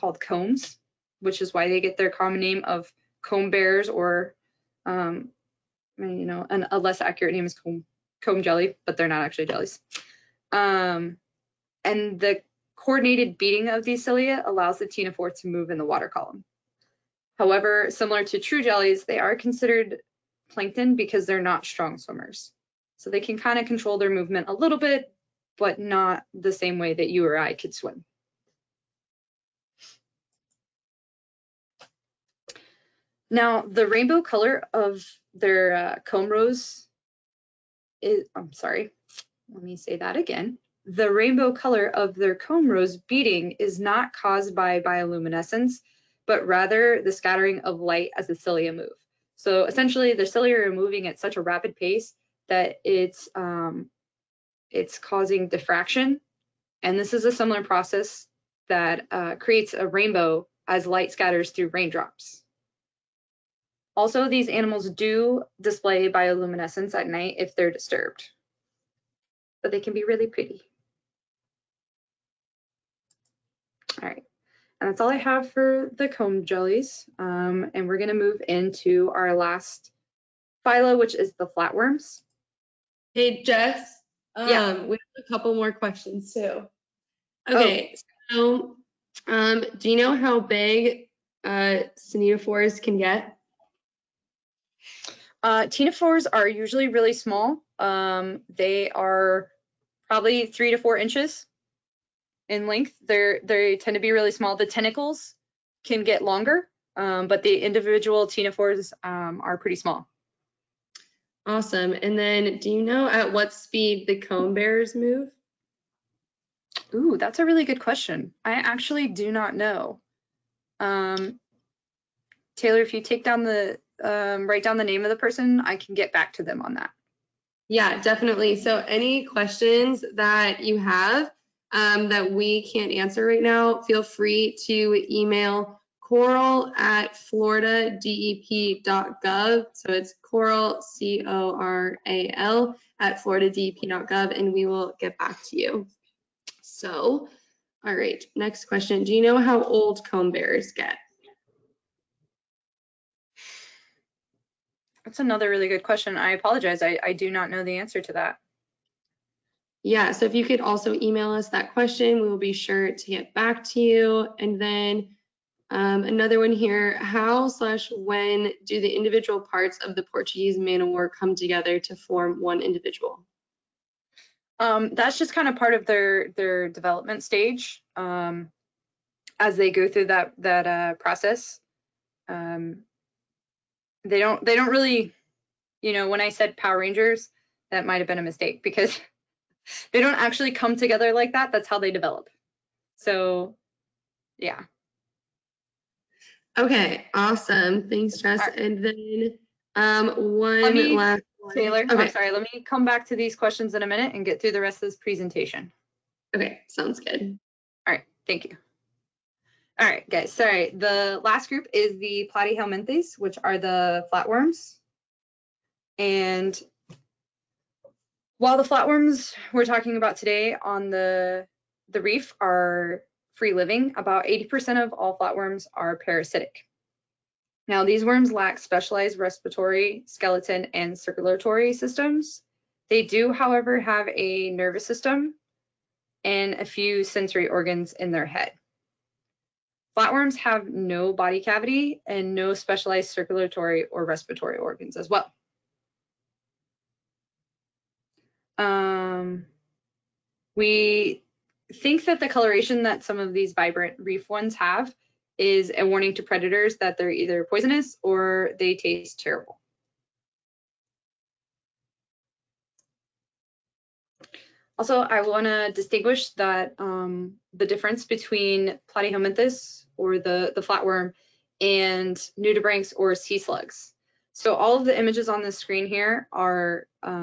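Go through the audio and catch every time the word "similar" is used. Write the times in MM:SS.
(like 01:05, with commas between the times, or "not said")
00:17, 00:57.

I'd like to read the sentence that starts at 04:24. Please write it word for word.
Also, I want to distinguish that um, the difference between platyhelminthes or the, the flatworm and nudibranchs or sea slugs.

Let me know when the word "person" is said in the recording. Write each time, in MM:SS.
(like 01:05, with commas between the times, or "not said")
02:05.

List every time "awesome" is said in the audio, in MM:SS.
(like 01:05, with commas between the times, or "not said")
01:51, 03:17.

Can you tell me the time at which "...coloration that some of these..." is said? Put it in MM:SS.
04:12.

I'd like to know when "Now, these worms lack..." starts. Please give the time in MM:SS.
03:47.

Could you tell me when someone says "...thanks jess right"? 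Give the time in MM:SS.
03:17.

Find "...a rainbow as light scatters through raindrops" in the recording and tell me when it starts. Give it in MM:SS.
00:59.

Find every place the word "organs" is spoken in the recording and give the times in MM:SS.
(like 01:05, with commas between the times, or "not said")
03:57, 04:04.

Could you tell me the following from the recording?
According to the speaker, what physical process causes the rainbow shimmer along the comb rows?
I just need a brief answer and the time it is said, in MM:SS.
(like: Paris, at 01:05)
scattering of light, at 00:47.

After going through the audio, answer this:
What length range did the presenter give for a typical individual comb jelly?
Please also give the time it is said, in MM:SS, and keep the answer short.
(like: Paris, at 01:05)
3 to 4 inches, at 01:40.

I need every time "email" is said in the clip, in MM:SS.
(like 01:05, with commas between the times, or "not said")
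02:15, 02:40.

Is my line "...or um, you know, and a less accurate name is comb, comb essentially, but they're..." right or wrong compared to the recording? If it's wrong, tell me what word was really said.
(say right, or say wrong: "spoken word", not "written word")
wrong: "jelly", not "essentially".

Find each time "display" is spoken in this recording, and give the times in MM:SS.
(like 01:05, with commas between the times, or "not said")
01:05.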